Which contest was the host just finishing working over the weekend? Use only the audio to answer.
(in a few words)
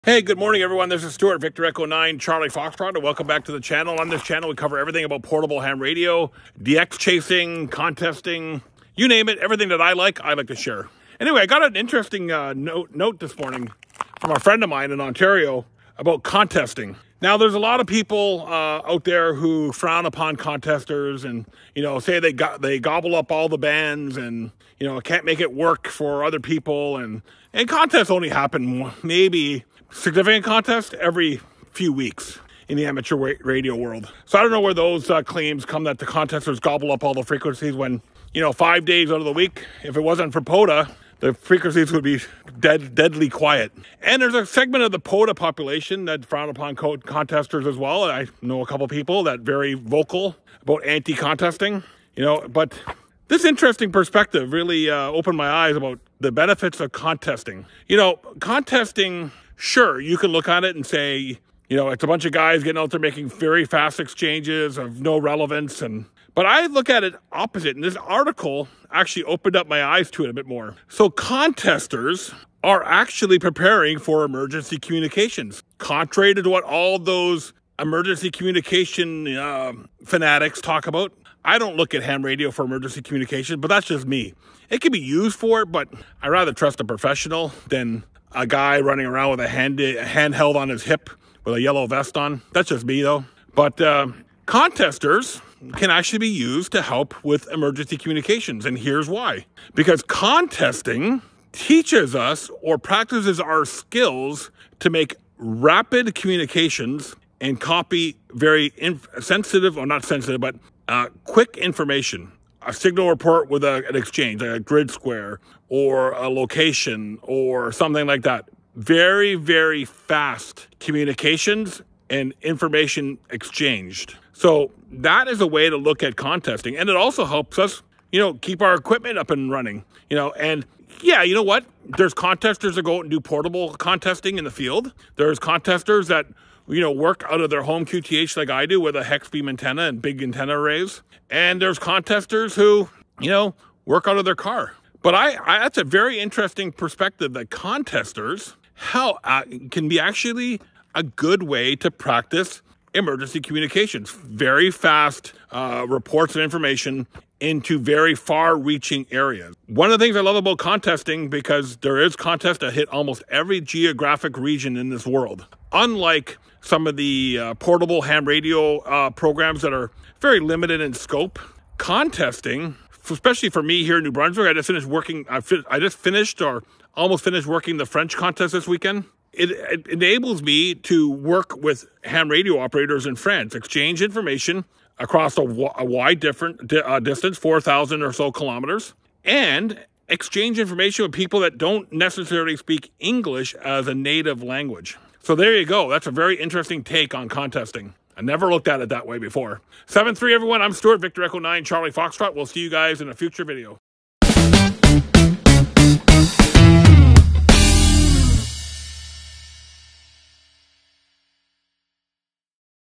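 The French contest.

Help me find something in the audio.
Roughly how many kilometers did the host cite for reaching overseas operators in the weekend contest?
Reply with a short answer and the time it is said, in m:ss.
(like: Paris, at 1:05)
4,000, at 3:07.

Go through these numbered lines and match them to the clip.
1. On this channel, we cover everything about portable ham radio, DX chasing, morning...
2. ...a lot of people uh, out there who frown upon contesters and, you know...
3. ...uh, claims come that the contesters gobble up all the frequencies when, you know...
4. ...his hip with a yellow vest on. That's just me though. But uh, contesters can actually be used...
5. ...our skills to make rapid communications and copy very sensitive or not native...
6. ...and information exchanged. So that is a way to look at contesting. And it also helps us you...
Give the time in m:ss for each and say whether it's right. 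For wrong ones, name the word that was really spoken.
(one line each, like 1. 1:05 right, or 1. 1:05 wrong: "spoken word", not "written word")
1. 0:04 wrong: "contesting", not "morning"
2. 0:17 right
3. 0:35 right
4. 1:30 right
5. 1:43 wrong: "sensitive", not "native"
6. 2:02 right.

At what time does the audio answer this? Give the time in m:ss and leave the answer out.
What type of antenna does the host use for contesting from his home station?
2:19.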